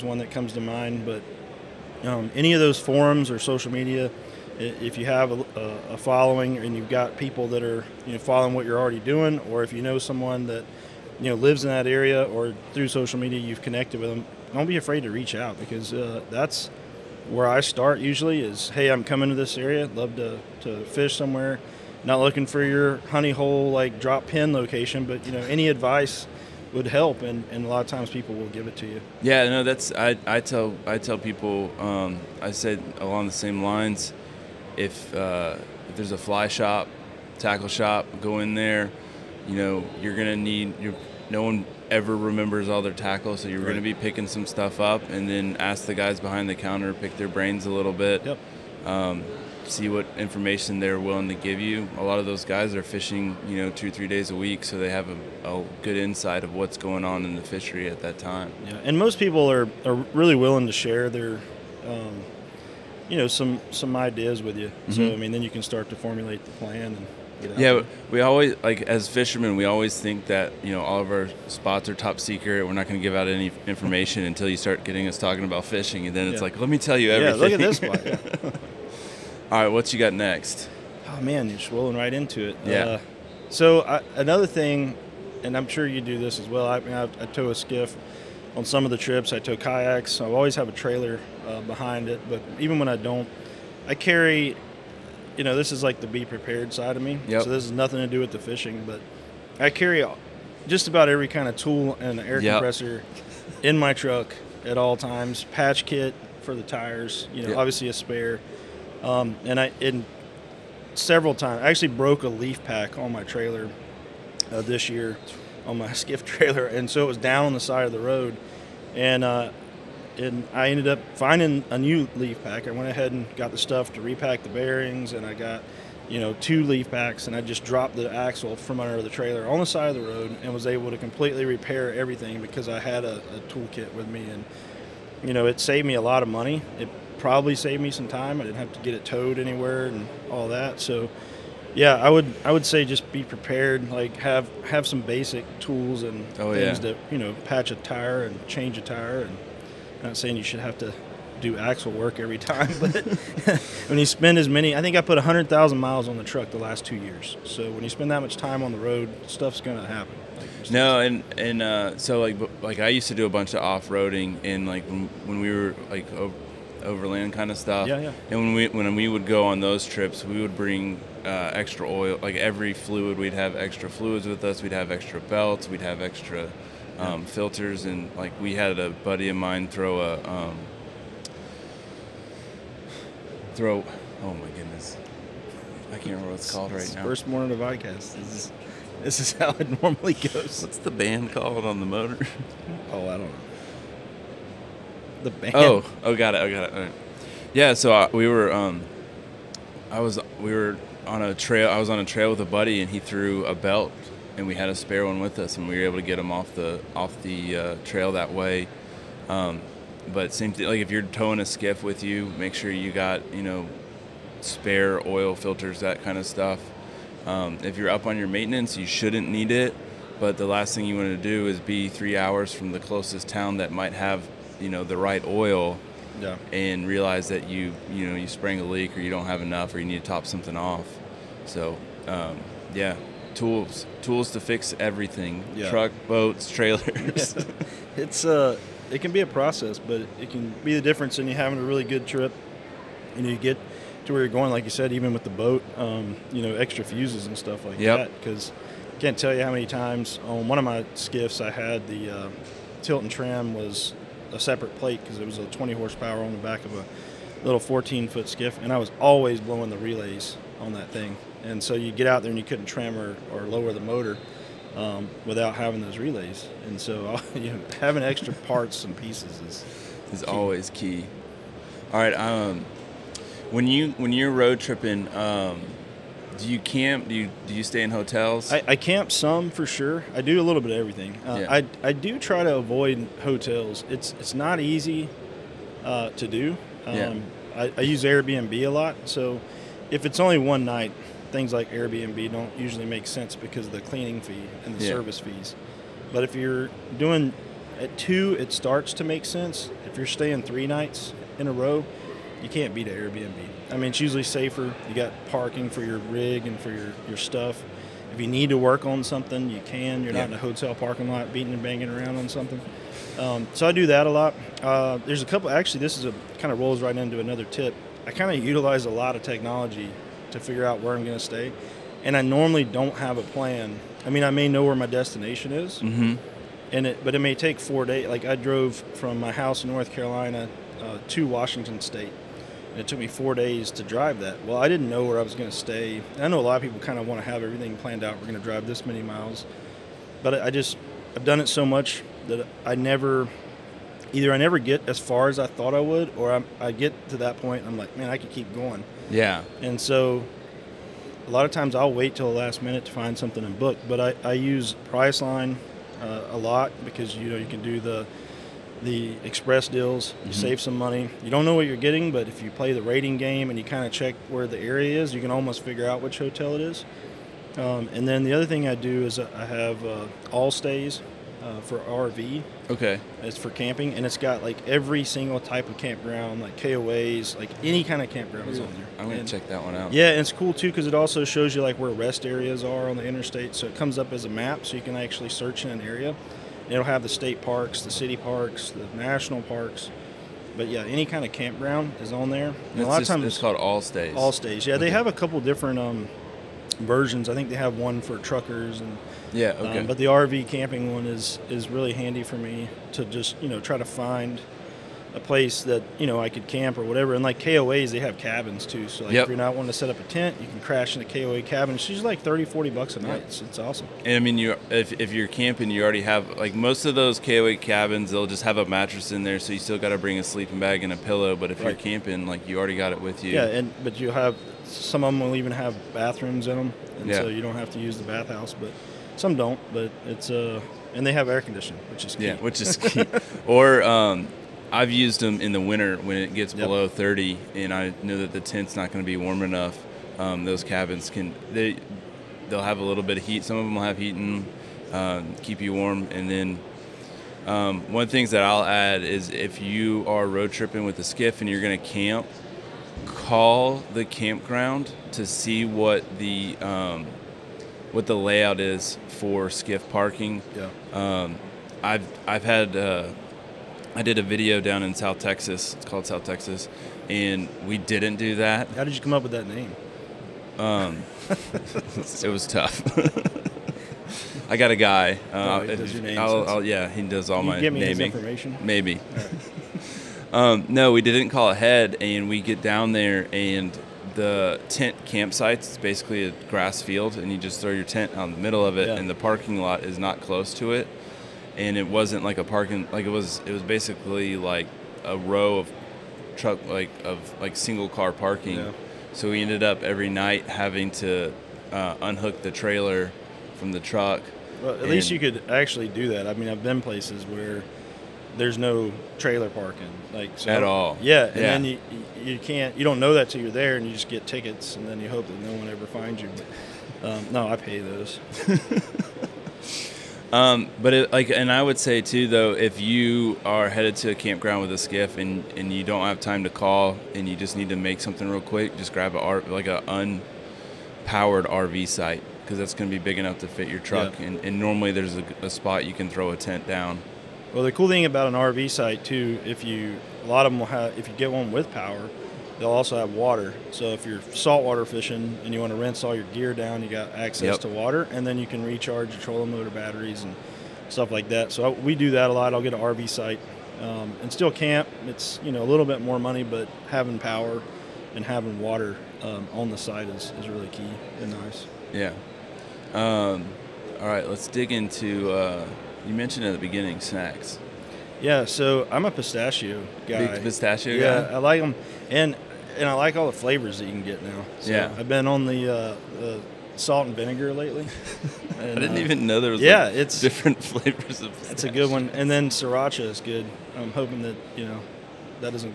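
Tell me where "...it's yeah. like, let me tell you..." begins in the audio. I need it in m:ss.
1:16.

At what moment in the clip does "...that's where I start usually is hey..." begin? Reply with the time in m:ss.
0:16.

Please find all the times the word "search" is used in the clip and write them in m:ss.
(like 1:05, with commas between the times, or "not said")
6:25.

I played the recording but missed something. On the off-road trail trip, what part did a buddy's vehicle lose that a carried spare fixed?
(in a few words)
belt.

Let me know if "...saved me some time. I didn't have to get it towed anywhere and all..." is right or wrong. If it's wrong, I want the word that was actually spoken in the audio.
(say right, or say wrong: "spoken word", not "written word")
right.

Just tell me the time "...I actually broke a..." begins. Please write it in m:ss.
1:51.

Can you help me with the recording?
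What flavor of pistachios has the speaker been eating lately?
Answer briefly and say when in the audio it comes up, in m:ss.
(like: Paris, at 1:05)
salt and vinegar, at 9:36.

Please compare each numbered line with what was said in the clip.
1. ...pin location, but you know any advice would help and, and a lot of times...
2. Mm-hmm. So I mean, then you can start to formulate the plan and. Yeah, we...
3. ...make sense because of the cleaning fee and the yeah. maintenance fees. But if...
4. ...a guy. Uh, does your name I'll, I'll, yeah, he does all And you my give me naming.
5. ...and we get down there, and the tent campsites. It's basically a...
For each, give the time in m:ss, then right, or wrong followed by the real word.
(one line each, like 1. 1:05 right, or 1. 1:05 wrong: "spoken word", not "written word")
1. 0:24 right
2. 1:04 right
3. 4:52 wrong: "service", not "maintenance"
4. 7:54 wrong: "Can", not "And"
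5. 8:02 right.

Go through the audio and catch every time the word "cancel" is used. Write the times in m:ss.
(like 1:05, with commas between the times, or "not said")
not said.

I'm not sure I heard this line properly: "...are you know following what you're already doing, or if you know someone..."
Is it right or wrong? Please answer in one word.
right.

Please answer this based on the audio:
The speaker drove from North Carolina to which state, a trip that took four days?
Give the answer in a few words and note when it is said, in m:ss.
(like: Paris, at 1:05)
Washington, at 5:31.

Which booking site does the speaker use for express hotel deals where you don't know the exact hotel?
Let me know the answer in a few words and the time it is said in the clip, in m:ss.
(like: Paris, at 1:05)
Priceline, at 5:54.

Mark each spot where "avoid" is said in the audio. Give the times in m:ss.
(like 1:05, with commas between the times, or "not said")
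4:42.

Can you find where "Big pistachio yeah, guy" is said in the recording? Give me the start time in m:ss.
9:30.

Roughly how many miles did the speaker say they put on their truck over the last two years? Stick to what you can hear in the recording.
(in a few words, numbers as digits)
100,000.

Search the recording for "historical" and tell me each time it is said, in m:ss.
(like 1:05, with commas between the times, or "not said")
not said.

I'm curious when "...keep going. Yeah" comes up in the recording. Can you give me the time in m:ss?
5:48.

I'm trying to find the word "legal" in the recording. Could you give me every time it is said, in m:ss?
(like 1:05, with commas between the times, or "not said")
not said.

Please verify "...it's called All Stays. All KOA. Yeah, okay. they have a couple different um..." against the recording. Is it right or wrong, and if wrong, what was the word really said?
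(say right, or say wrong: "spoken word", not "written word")
wrong: "Stays", not "KOA".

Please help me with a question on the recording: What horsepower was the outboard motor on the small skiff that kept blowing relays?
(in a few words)
20.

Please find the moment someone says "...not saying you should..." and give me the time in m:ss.
2:30.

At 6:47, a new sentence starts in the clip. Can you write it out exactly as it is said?
And like KOAs, they have cabins too.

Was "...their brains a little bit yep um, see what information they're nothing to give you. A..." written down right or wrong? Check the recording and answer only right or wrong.
wrong.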